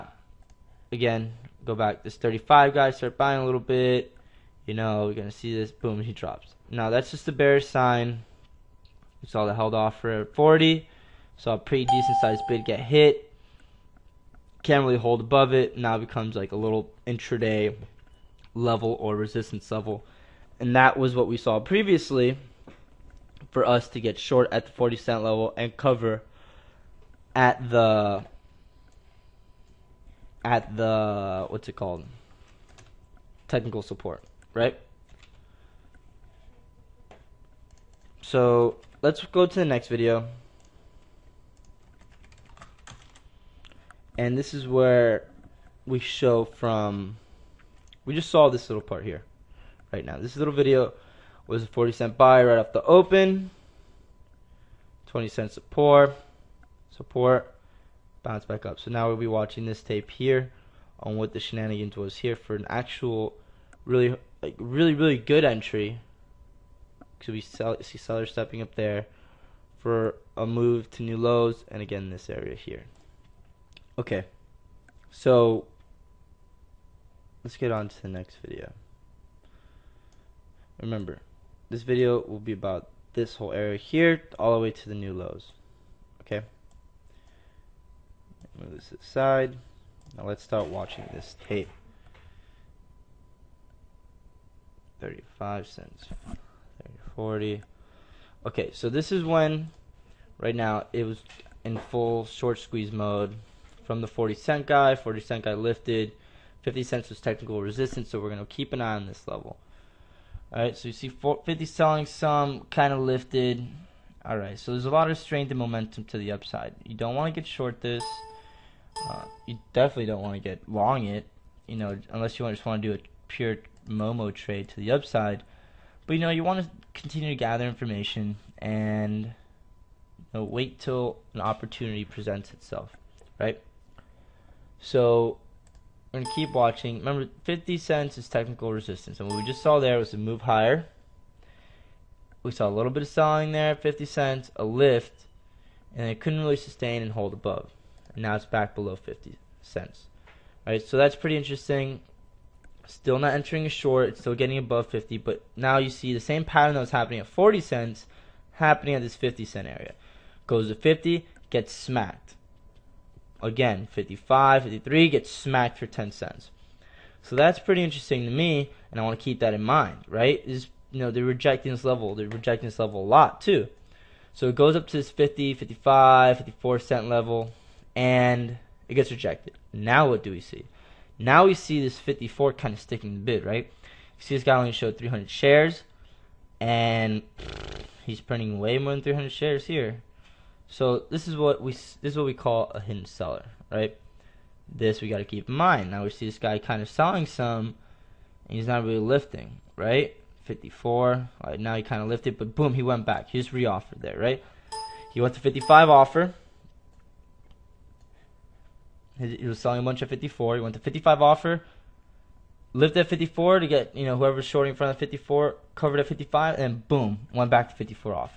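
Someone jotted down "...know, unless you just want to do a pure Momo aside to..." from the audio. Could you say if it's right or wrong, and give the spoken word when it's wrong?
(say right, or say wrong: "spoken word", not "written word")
wrong: "trade", not "aside".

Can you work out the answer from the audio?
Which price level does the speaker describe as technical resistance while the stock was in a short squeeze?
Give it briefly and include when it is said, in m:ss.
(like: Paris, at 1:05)
50 cents, at 1:46.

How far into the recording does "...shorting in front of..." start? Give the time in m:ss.
3:34.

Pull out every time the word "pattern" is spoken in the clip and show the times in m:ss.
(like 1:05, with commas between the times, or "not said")
2:36.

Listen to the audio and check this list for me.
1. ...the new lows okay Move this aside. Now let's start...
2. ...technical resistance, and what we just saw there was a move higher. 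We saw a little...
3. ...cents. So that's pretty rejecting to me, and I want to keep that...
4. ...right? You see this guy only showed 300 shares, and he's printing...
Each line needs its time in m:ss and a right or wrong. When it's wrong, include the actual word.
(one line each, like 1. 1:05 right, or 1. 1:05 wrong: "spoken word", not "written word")
1. 1:24 right
2. 2:18 right
3. 2:46 wrong: "interesting", not "rejecting"
4. 3:03 right.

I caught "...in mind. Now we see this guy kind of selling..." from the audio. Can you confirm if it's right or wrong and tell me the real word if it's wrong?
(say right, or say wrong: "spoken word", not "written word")
right.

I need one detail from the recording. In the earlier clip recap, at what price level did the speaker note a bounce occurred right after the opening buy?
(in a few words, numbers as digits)
20 cents.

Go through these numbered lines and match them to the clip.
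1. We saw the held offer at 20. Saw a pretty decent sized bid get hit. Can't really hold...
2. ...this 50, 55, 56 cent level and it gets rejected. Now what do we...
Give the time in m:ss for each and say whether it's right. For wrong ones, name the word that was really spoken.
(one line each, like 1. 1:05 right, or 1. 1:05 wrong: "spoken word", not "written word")
1. 0:09 wrong: "40", not "20"
2. 2:54 wrong: "54", not "56".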